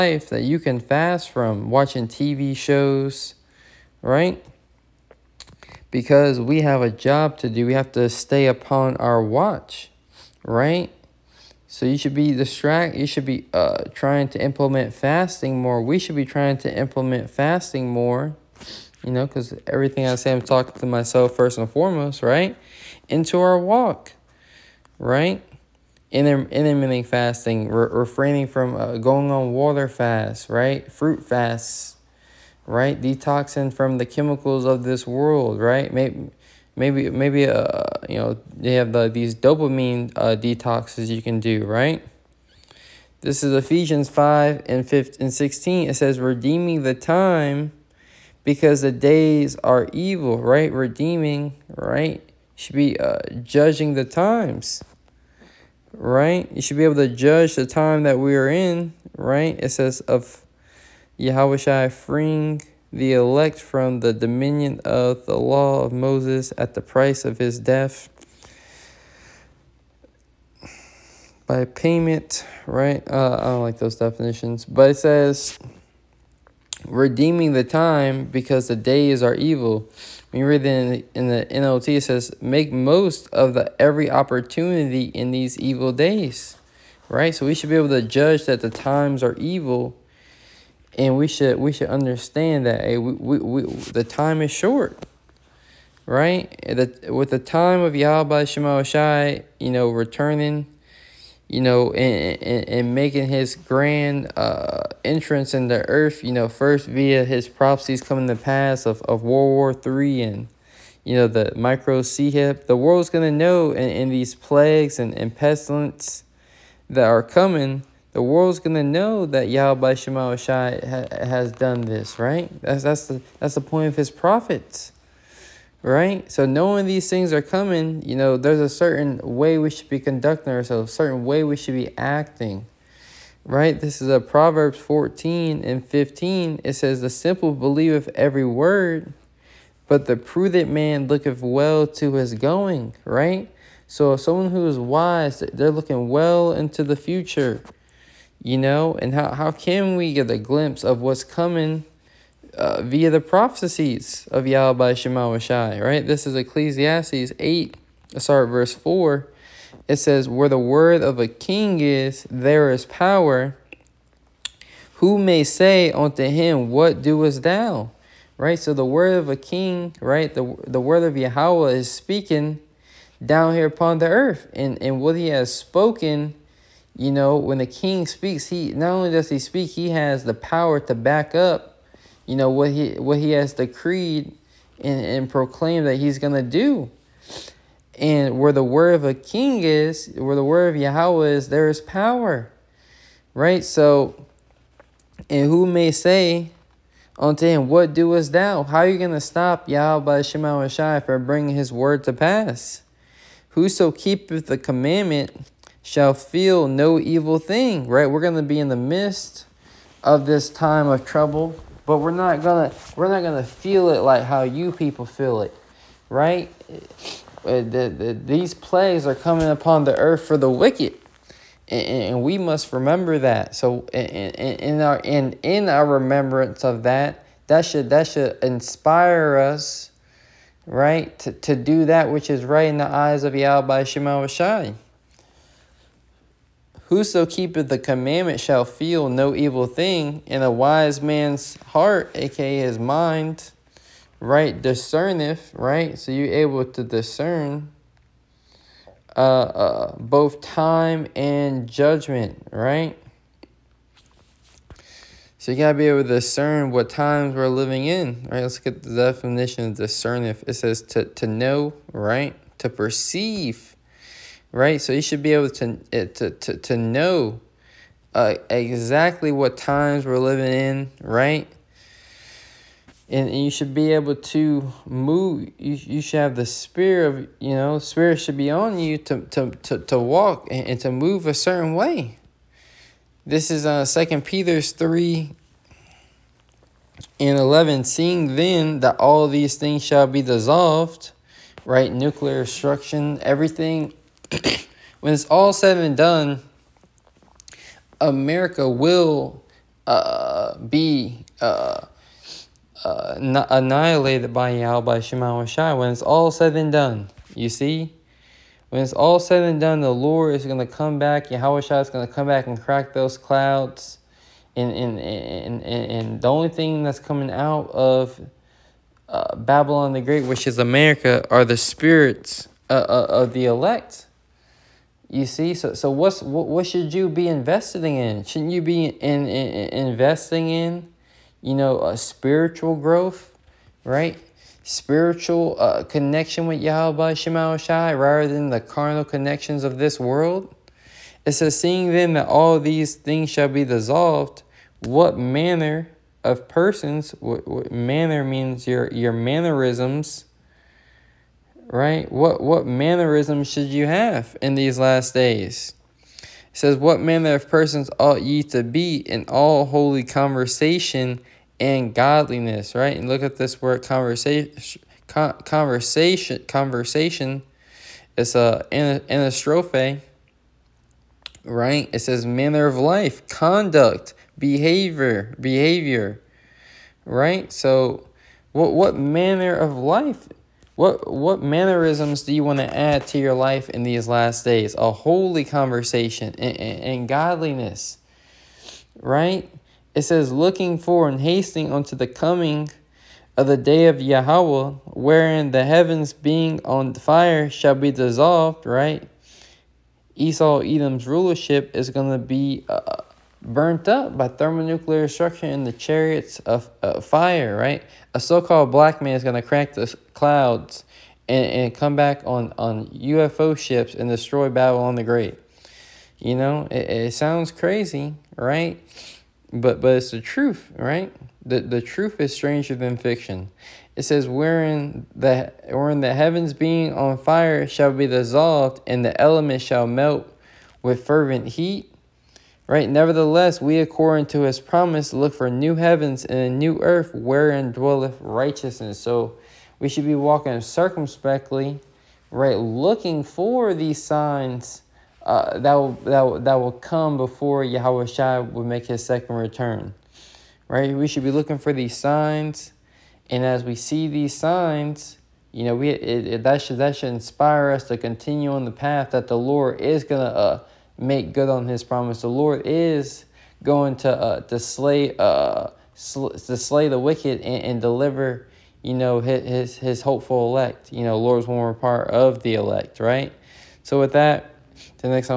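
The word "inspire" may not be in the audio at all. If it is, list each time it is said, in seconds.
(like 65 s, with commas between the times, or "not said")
228 s, 457 s.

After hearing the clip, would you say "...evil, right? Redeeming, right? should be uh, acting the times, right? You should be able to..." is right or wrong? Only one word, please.
wrong.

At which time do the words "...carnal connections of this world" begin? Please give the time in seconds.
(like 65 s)
338 s.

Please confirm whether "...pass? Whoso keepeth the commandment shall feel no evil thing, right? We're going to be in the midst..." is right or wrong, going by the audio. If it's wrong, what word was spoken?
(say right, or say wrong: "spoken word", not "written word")
right.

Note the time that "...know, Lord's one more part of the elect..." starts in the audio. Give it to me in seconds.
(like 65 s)
471 s.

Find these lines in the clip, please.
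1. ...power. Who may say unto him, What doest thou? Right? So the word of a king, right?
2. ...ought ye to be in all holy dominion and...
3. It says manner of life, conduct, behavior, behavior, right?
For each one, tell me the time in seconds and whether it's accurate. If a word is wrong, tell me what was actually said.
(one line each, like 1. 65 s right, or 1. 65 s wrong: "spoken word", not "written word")
1. 162 s right
2. 357 s wrong: "conversation", not "dominion"
3. 371 s right.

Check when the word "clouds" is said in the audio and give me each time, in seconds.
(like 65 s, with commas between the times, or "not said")
313 s, 410 s.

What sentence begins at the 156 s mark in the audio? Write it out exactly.
This is Ecclesiastes 8, sorry, verse 4.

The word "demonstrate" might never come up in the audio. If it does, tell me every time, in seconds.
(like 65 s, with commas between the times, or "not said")
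not said.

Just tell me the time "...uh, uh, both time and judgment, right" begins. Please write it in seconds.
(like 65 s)
249 s.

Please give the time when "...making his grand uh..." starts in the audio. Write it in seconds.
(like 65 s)
102 s.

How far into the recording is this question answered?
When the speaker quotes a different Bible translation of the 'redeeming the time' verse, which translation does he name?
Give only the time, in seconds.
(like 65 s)
81 s.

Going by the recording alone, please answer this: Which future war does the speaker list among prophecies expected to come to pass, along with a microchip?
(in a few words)
World War Three.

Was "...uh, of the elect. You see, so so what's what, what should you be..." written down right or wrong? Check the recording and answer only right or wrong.
right.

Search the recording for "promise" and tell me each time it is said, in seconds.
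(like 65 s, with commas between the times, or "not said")
434 s, 461 s.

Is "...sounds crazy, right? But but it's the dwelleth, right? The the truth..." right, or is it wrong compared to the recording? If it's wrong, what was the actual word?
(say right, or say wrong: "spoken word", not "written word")
wrong: "truth", not "dwelleth".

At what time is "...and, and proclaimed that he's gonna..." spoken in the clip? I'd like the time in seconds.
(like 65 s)
184 s.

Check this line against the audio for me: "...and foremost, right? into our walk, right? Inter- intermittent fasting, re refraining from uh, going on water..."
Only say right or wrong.
right.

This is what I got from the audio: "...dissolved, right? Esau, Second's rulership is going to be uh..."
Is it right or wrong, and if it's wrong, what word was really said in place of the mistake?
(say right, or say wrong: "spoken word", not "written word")
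wrong: "Edom", not "Second".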